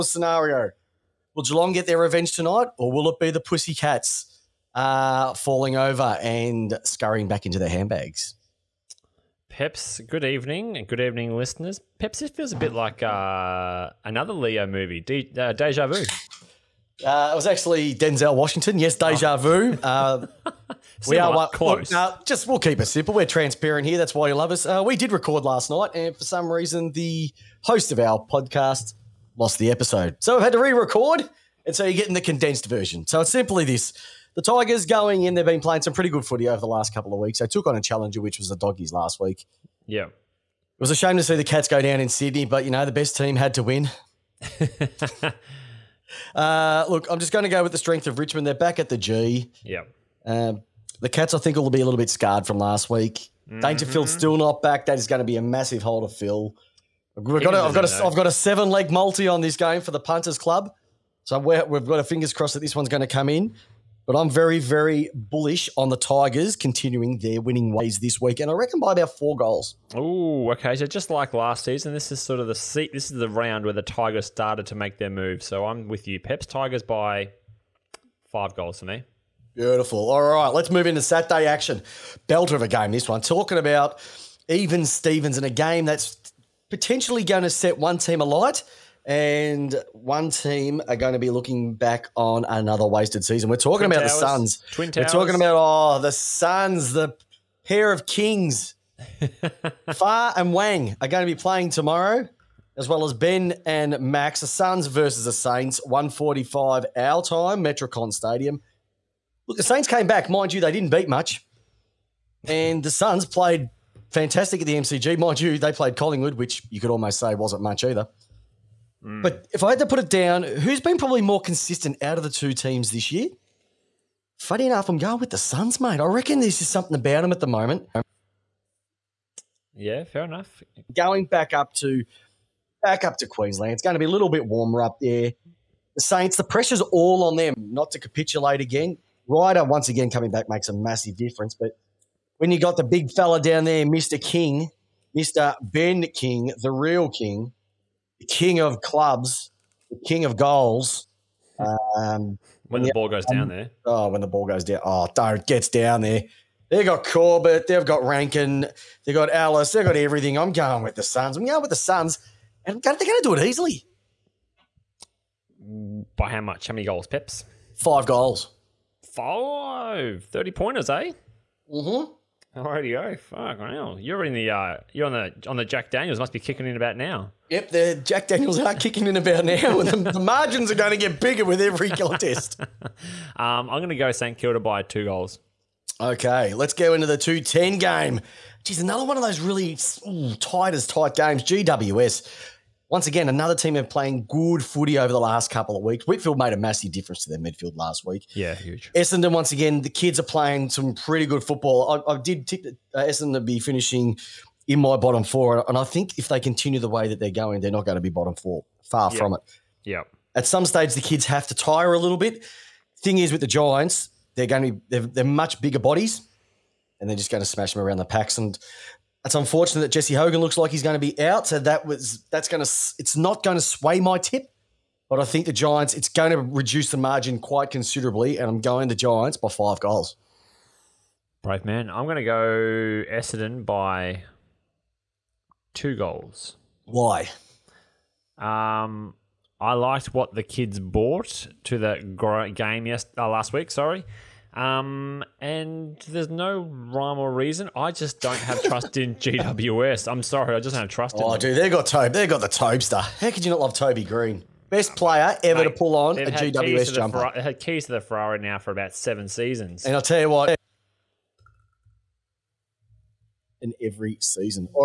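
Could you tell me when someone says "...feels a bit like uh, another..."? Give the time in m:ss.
0:12.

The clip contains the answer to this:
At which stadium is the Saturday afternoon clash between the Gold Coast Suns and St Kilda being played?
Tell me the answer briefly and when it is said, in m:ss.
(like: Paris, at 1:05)
Metricon Stadium, at 1:47.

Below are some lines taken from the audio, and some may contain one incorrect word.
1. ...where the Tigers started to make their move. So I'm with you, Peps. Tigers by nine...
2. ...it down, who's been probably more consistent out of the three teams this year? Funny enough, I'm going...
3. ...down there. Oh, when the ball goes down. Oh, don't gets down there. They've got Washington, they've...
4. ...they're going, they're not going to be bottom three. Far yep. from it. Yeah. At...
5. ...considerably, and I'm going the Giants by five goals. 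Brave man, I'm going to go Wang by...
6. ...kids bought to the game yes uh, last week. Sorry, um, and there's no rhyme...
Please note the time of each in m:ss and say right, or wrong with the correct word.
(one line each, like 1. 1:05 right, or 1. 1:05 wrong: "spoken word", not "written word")
1. 1:13 wrong: "five", not "nine"
2. 1:59 wrong: "two", not "three"
3. 2:33 wrong: "Corbett", not "Washington"
4. 3:27 wrong: "four", not "three"
5. 3:47 wrong: "Essendon", not "Wang"
6. 4:00 right.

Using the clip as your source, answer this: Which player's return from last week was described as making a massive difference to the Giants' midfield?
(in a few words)
Whitfield.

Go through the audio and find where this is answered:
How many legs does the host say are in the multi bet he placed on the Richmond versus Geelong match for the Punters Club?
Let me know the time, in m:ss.
0:58.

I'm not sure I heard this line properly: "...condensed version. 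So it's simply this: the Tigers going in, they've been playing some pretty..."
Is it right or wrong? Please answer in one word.
right.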